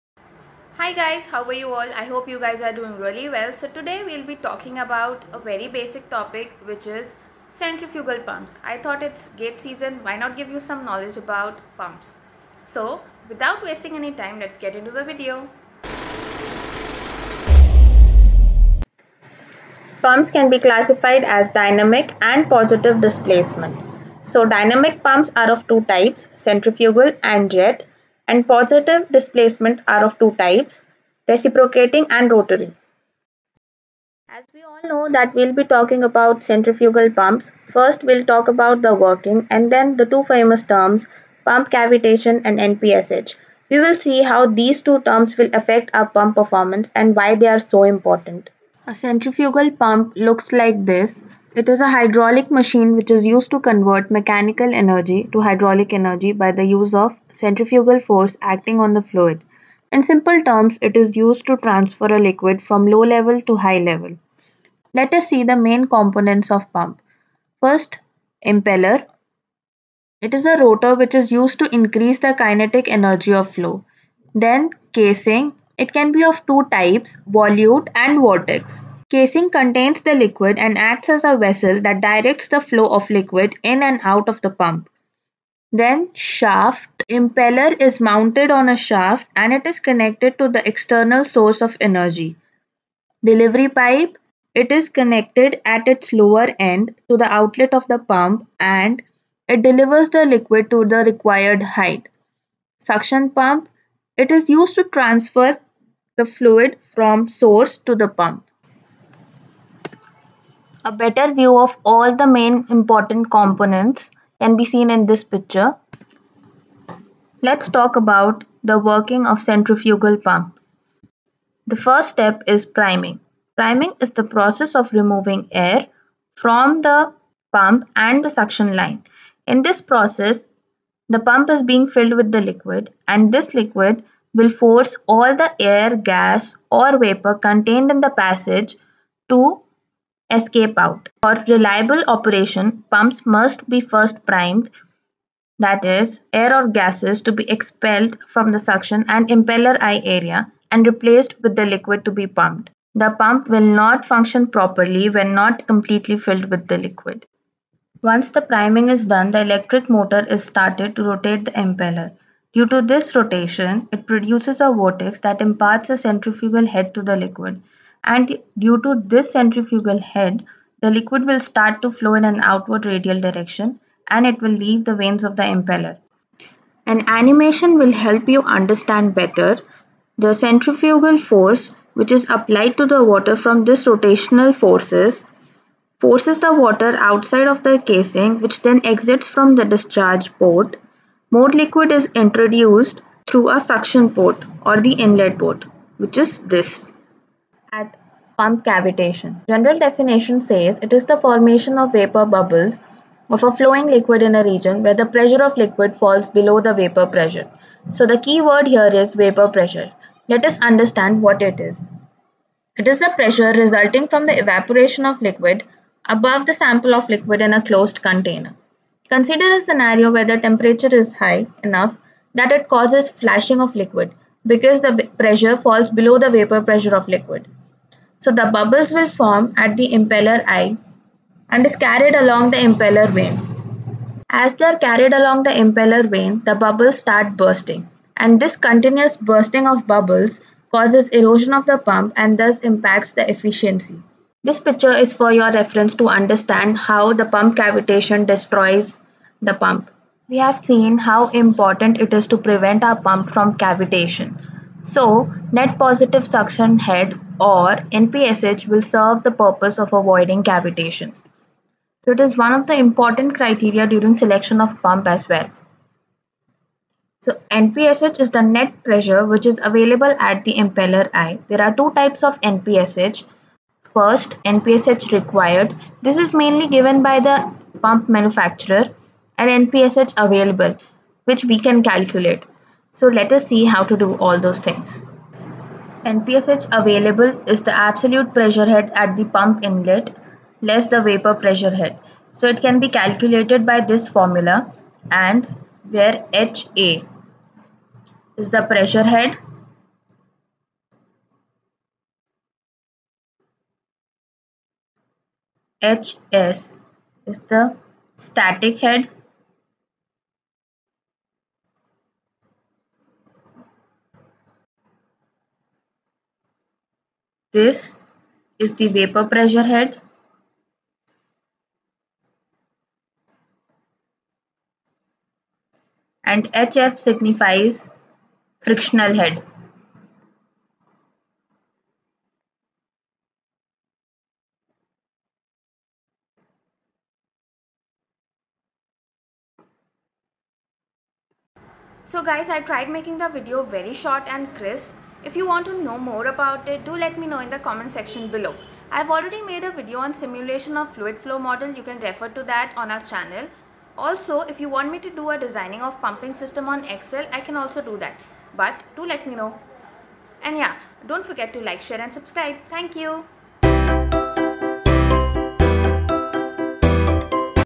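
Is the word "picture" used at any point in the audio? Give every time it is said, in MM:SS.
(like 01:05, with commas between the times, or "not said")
01:55, 04:04.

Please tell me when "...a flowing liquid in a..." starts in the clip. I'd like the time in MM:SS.
03:23.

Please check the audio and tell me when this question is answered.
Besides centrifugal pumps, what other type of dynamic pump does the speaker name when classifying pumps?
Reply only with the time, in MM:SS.
00:27.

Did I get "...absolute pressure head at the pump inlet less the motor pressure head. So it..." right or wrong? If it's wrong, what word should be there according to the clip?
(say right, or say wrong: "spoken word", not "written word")
wrong: "vapor", not "motor".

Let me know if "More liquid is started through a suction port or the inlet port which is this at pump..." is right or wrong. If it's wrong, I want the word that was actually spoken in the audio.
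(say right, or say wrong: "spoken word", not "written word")
wrong: "introduced", not "started".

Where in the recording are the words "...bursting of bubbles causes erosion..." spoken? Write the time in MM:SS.
03:59.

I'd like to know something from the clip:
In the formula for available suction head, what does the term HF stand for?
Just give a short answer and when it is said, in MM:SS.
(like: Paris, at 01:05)
Frictional head, at 05:28.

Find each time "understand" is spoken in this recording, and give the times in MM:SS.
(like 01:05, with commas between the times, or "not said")
02:58, 03:30, 04:06.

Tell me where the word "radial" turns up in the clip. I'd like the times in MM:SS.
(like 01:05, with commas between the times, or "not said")
02:52.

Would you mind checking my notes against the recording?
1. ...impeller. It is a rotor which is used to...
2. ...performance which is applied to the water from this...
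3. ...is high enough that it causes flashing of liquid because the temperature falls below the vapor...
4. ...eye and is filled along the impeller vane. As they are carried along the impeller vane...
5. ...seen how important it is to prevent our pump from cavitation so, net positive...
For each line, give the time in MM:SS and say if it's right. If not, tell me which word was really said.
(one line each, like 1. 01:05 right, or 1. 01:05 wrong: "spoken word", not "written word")
1. 01:08 right
2. 03:01 wrong: "force", not "performance"
3. 03:40 wrong: "pressure", not "temperature"
4. 03:50 wrong: "carried", not "filled"
5. 04:10 right.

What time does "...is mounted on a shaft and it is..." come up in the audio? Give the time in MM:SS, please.
01:27.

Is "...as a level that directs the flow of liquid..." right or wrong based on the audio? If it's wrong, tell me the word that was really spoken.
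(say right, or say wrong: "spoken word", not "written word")
wrong: "vessel", not "level".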